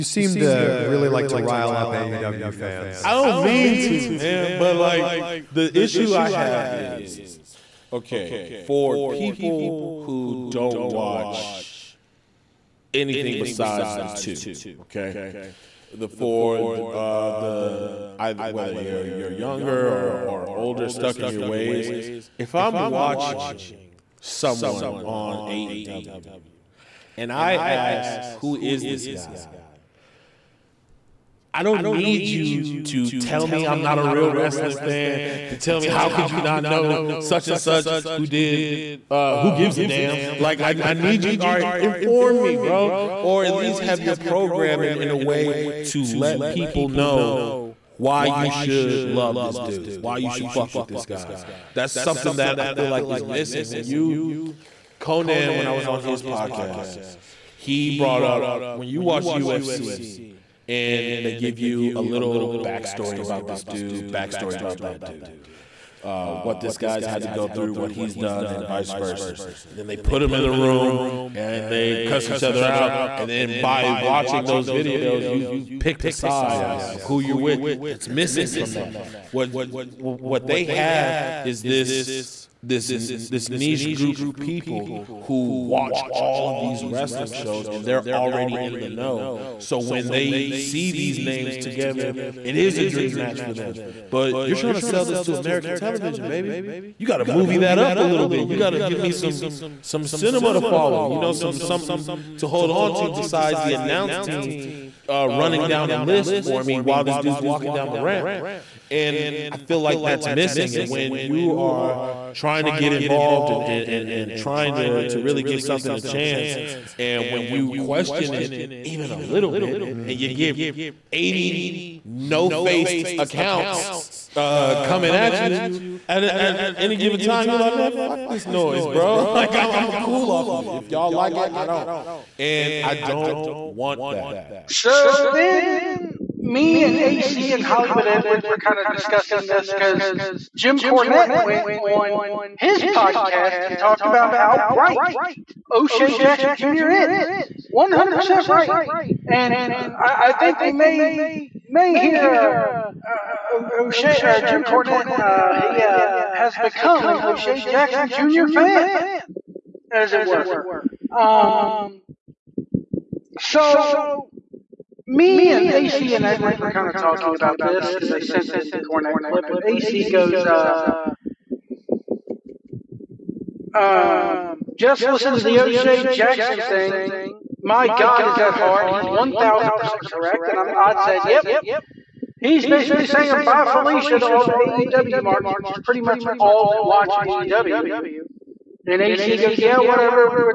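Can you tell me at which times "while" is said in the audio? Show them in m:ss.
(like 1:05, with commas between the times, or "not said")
1:46.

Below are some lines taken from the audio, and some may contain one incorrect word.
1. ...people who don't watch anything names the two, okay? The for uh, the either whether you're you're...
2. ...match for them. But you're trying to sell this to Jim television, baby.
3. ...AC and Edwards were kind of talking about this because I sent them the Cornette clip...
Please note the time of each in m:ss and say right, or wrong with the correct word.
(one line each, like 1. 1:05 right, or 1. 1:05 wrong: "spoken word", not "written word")
1. 0:08 wrong: "besides", not "names"
2. 1:33 wrong: "American", not "Jim"
3. 2:45 right.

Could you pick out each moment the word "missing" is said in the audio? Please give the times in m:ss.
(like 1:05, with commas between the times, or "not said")
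0:53, 1:18, 1:50.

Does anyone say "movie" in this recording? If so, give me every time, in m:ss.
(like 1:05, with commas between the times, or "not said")
1:37.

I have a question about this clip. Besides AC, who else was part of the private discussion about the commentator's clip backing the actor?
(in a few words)
Hollywood Edwards.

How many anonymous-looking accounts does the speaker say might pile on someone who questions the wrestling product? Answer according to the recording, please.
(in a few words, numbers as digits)
80.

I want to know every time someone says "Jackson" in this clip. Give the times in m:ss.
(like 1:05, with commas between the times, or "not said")
2:26, 2:37, 2:56.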